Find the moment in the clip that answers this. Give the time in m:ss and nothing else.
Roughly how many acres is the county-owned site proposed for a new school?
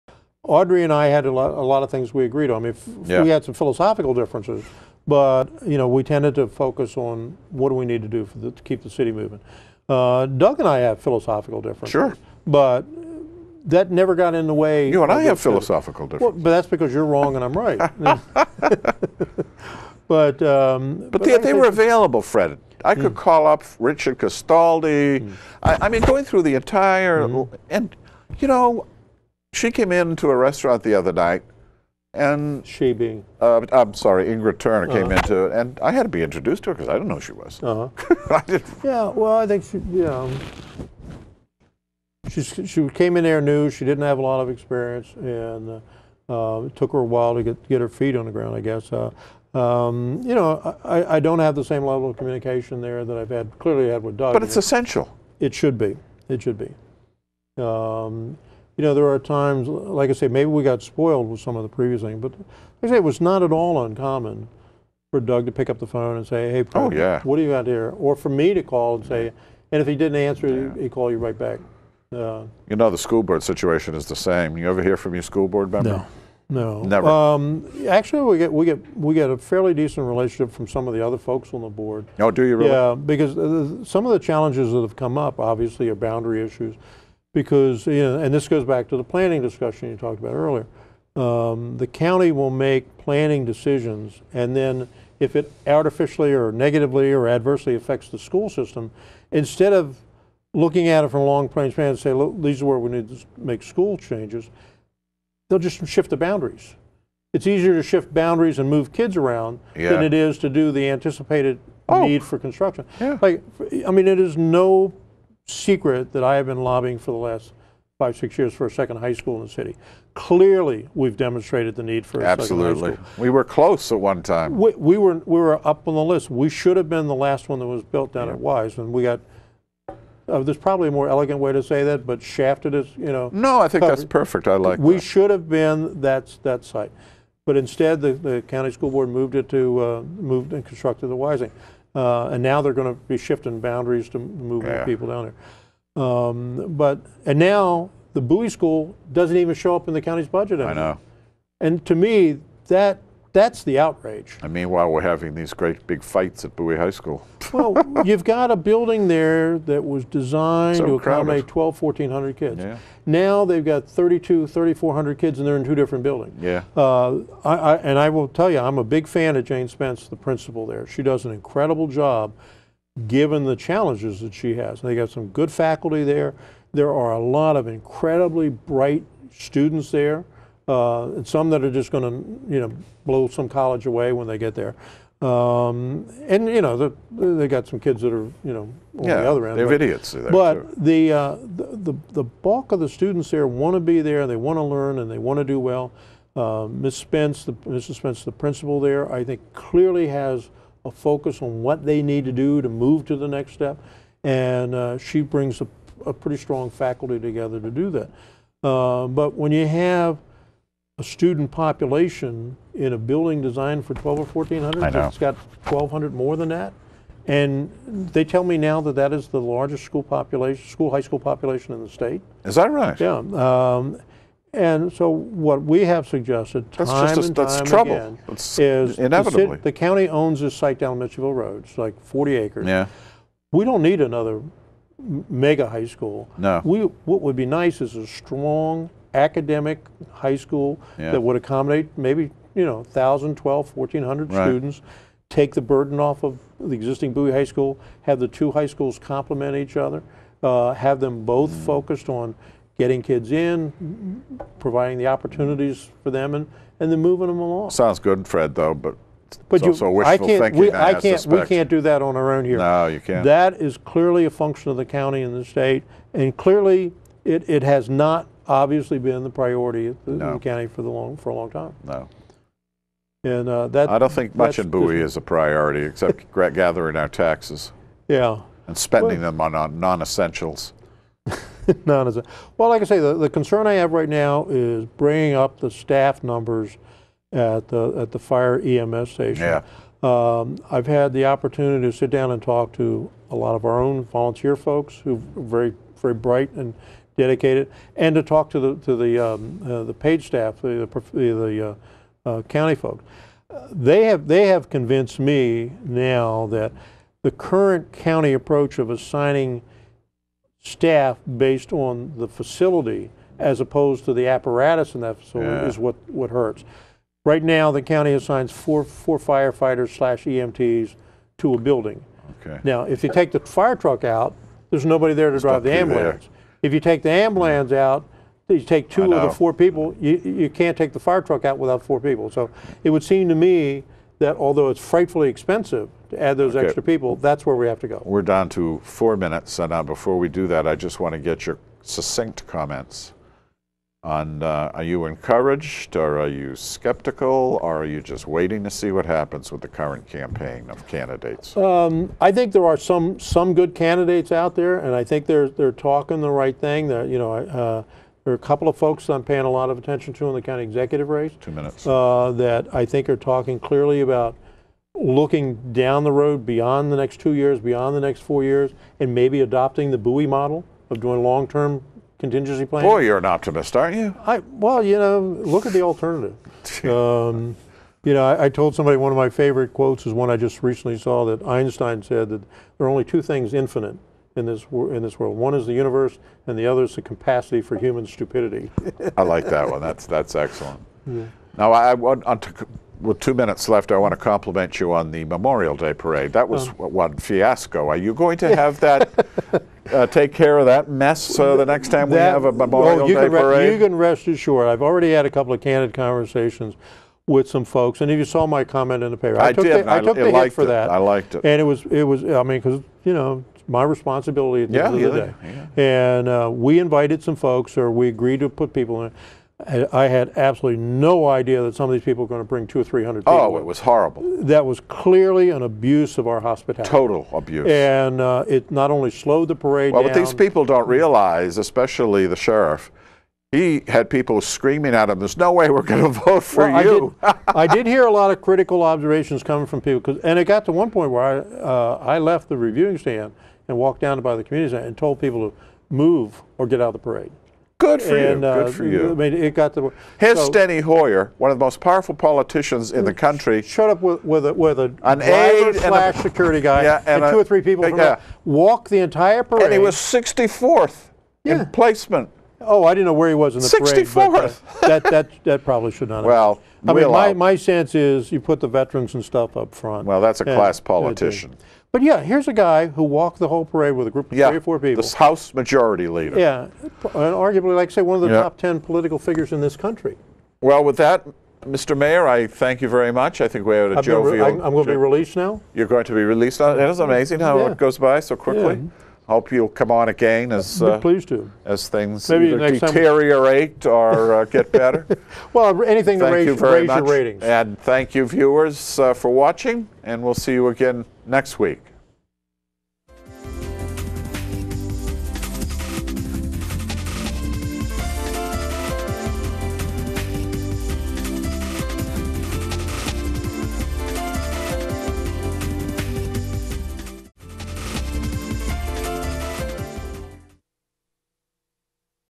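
3:52.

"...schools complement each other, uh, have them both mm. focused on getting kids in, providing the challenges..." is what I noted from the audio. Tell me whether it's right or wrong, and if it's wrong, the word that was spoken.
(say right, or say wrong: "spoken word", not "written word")
wrong: "opportunities", not "challenges".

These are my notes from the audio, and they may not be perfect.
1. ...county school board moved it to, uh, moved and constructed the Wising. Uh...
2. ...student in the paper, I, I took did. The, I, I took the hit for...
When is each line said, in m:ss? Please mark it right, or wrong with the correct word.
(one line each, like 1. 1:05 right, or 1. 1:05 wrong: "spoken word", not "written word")
1. 2:18 right
2. 6:48 wrong: "comment", not "student".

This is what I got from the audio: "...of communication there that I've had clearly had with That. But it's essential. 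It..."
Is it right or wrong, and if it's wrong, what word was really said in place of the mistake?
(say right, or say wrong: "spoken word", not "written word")
wrong: "Doug", not "That".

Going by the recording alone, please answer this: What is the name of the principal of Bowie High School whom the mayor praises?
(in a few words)
Jane Spence.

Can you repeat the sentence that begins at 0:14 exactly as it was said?
You and I have philosophical differences.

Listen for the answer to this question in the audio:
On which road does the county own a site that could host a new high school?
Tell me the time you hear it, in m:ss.
3:50.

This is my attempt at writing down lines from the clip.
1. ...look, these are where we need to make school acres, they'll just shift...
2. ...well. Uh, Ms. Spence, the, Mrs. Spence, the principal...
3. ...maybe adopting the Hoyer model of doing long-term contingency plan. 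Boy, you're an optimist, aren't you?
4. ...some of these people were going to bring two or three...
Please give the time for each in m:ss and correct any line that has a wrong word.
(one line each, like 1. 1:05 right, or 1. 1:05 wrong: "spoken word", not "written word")
1. 1:42 wrong: "changes", not "acres"
2. 3:15 right
3. 6:09 wrong: "Bowie", not "Hoyer"
4. 7:01 right.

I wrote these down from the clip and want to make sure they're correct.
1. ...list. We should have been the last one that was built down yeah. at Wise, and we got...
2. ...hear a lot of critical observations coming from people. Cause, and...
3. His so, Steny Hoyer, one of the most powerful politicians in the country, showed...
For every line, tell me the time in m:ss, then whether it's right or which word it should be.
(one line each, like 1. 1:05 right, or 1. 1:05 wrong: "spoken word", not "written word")
1. 2:06 right
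2. 7:17 right
3. 7:30 right.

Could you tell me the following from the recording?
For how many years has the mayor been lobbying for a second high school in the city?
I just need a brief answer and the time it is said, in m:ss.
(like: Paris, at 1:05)
five, six years, at 1:57.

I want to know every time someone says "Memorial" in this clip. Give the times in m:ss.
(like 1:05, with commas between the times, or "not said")
6:35, 6:42.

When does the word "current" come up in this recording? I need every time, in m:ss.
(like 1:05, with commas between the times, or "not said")
5:07, 5:49.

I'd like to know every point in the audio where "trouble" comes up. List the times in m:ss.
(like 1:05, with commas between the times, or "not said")
3:47.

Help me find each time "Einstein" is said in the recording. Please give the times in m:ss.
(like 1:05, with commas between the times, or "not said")
6:21.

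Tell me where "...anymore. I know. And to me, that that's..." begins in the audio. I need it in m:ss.
2:30.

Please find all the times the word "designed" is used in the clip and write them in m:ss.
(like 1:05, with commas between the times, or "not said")
2:40, 3:33.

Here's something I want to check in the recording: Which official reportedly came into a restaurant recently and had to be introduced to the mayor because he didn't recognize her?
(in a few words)
Ingrid Turner.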